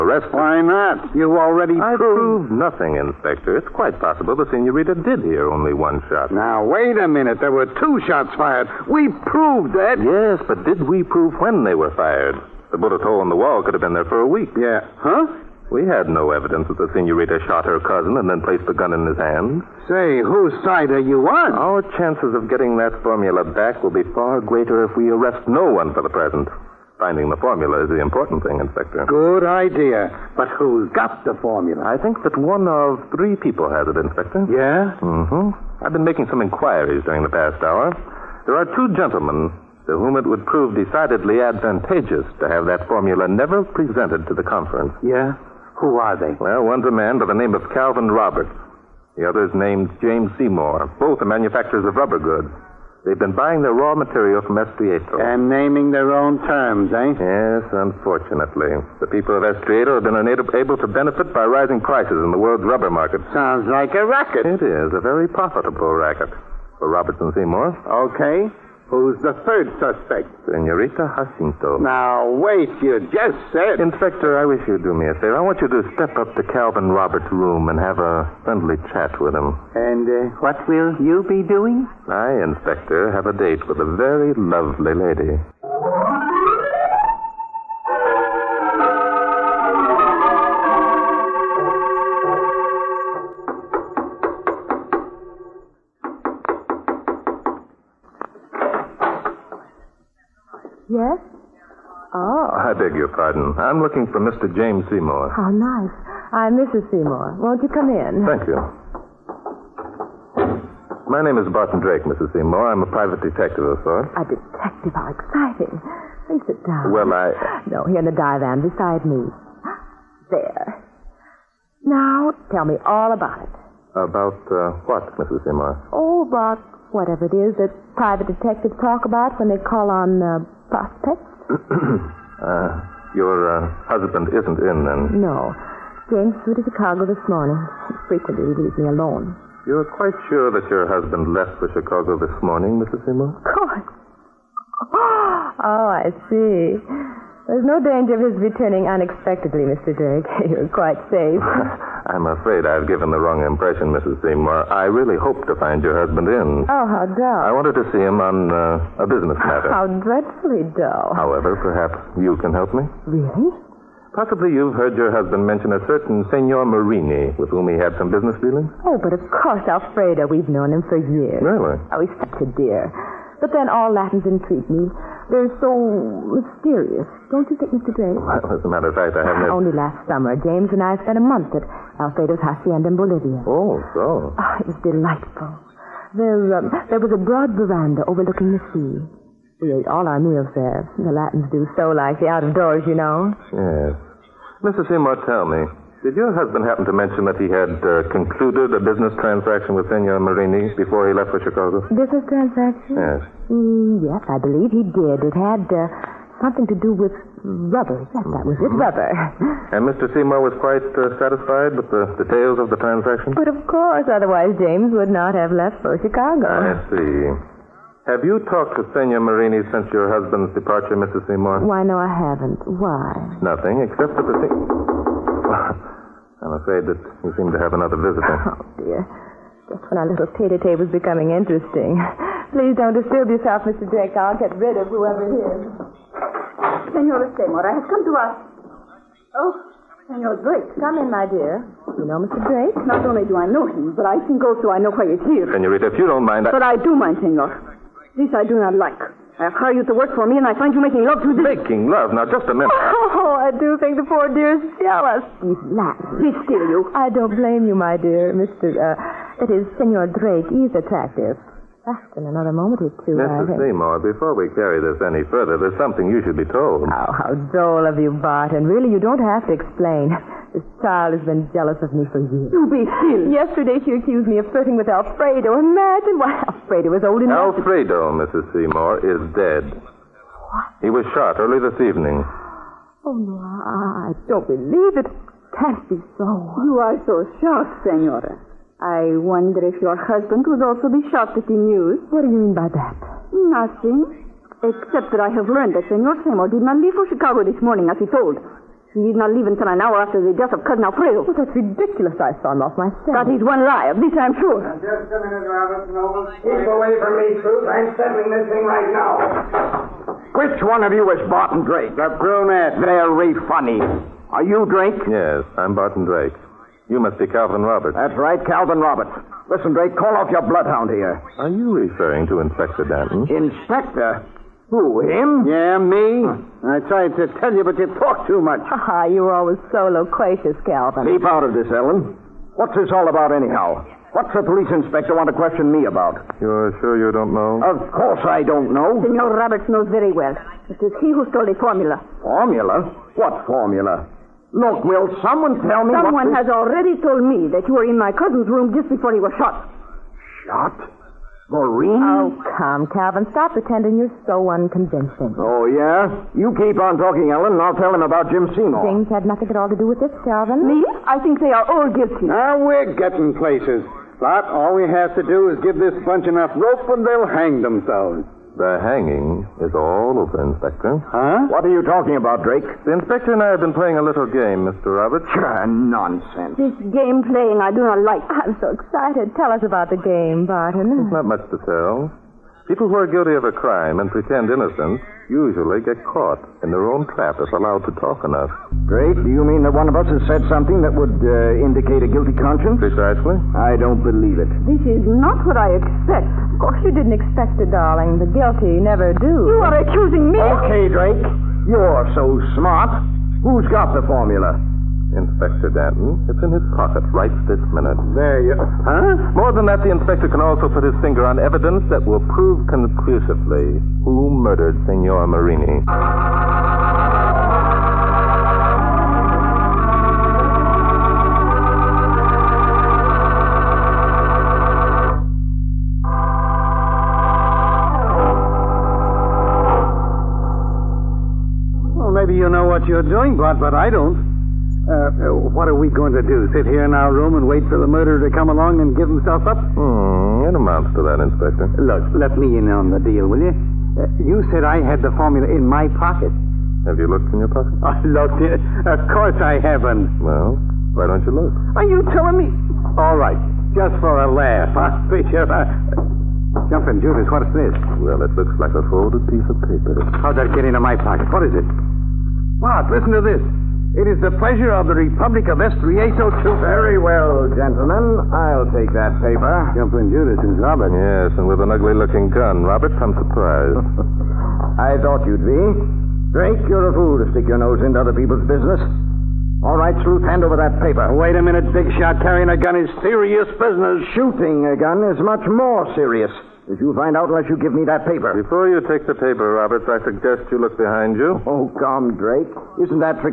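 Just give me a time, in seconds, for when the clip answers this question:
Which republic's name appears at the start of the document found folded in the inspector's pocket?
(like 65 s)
465 s.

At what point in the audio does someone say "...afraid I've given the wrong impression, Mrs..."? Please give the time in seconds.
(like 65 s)
152 s.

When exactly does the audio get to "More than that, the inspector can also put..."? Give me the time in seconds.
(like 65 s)
409 s.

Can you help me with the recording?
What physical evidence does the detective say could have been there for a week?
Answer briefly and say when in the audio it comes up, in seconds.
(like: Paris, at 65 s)
The bullet hole in the wall, at 12 s.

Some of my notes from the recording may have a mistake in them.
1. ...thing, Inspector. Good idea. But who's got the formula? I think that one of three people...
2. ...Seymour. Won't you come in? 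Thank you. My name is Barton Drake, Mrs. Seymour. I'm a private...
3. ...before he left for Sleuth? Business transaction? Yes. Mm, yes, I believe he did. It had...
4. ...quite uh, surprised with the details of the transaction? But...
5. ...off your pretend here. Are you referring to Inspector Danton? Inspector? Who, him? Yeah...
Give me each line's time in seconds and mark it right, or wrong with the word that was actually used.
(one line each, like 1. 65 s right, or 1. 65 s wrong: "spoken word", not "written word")
1. 28 s right
2. 106 s right
3. 200 s wrong: "Chicago", not "Sleuth"
4. 210 s wrong: "satisfied", not "surprised"
5. 320 s wrong: "bloodhound", not "pretend".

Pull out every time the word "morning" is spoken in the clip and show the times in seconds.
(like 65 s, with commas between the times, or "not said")
137 s, 142 s, 297 s.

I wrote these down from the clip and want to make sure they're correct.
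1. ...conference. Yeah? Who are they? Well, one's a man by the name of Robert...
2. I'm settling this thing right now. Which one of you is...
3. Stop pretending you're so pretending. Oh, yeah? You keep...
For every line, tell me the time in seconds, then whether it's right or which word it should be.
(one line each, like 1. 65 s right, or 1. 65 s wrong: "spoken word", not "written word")
1. 44 s wrong: "Calvin", not "Robert"
2. 307 s right
3. 353 s wrong: "unconvincing", not "pretending".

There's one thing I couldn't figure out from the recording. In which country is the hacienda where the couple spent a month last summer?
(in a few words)
Bolivia.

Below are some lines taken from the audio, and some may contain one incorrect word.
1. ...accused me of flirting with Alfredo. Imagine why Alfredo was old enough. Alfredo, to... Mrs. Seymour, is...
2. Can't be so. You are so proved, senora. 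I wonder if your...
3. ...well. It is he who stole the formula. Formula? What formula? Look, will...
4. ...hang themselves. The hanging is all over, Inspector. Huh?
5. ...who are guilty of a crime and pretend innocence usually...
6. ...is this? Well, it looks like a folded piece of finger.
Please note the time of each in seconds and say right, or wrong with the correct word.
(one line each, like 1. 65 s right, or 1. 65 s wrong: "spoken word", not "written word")
1. 273 s right
2. 285 s wrong: "shocked", not "proved"
3. 340 s right
4. 367 s right
5. 382 s right
6. 457 s wrong: "paper", not "finger".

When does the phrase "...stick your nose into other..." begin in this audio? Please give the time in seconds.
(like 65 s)
477 s.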